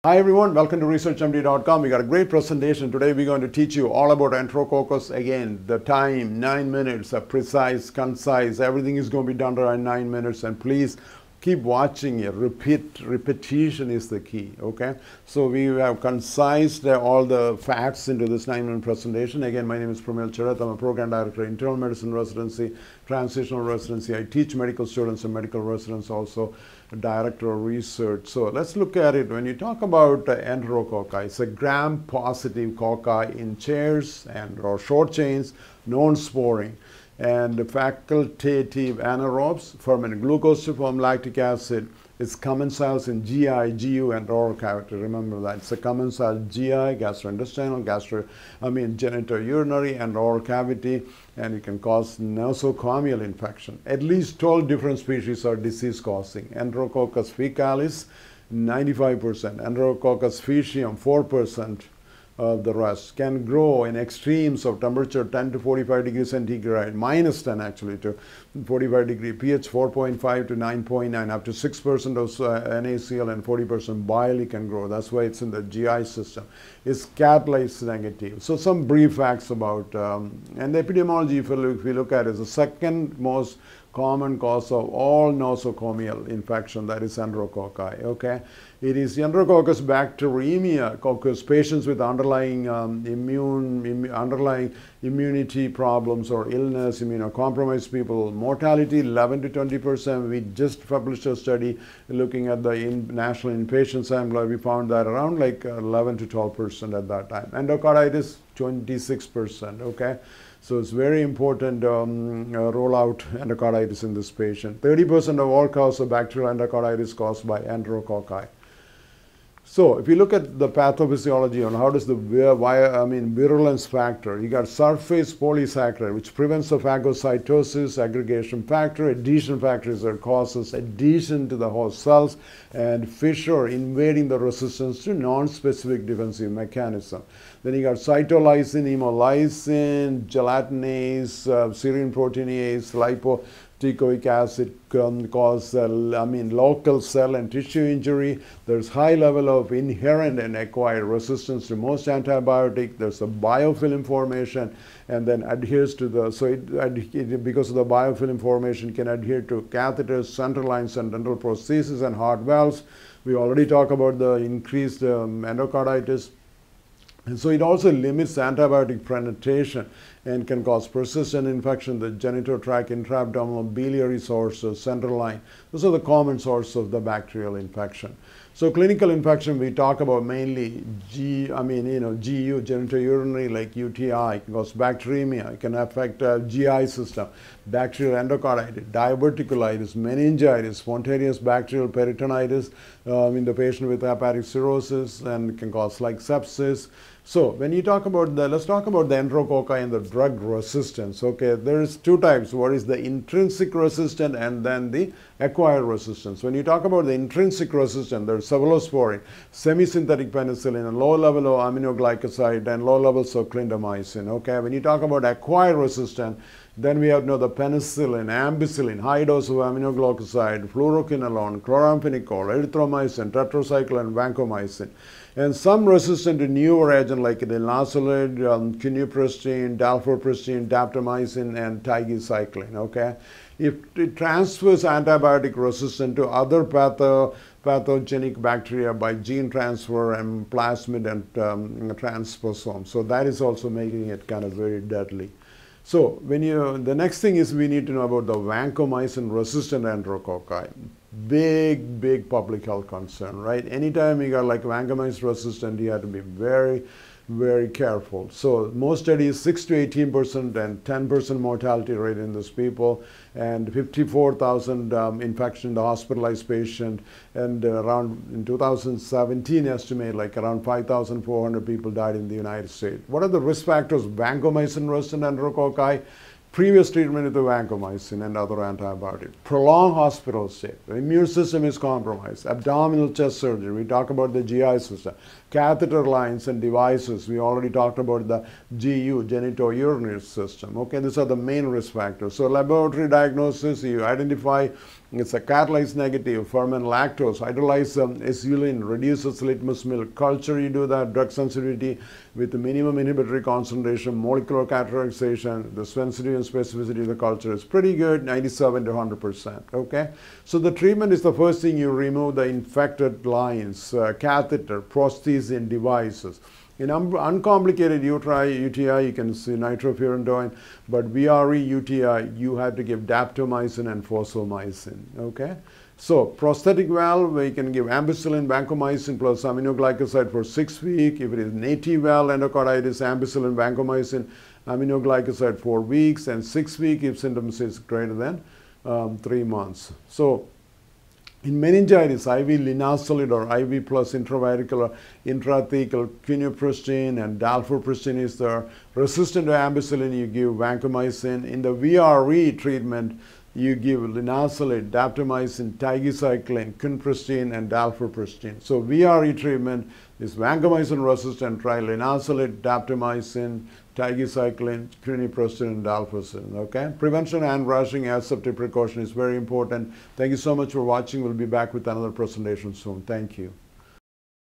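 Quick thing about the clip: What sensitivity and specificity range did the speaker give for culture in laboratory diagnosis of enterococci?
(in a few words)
97 to 100%.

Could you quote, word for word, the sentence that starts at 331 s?
If it is native valve endocarditis, ampicillin, vancomycin, aminoglycoside four weeks, and six weeks if symptoms is greater than um, three months.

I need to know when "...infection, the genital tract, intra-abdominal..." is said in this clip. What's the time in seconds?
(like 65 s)
171 s.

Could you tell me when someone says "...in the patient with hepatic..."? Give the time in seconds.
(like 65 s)
193 s.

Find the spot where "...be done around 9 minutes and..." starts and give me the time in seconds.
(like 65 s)
9 s.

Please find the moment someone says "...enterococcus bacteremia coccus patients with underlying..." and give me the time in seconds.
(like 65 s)
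89 s.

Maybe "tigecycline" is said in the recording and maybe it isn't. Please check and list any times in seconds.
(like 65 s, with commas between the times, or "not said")
231 s, 355 s, 363 s.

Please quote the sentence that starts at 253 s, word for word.
Anytime you got like vancomycin resistant, you have to be very very careful.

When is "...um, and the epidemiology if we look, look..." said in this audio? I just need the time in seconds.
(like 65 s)
79 s.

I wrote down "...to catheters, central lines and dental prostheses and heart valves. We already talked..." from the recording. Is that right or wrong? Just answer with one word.
right.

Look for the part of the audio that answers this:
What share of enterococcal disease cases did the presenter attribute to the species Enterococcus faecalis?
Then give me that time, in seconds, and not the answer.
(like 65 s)
58 s.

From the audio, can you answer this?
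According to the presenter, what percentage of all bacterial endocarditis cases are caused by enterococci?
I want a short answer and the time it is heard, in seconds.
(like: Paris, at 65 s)
30%, at 114 s.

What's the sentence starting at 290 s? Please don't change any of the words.
Okay, these are the main risk factors.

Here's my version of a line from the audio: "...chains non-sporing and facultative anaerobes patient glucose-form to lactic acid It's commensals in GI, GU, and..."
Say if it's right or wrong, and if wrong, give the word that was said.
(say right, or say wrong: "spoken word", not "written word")
wrong: "ferment", not "patient".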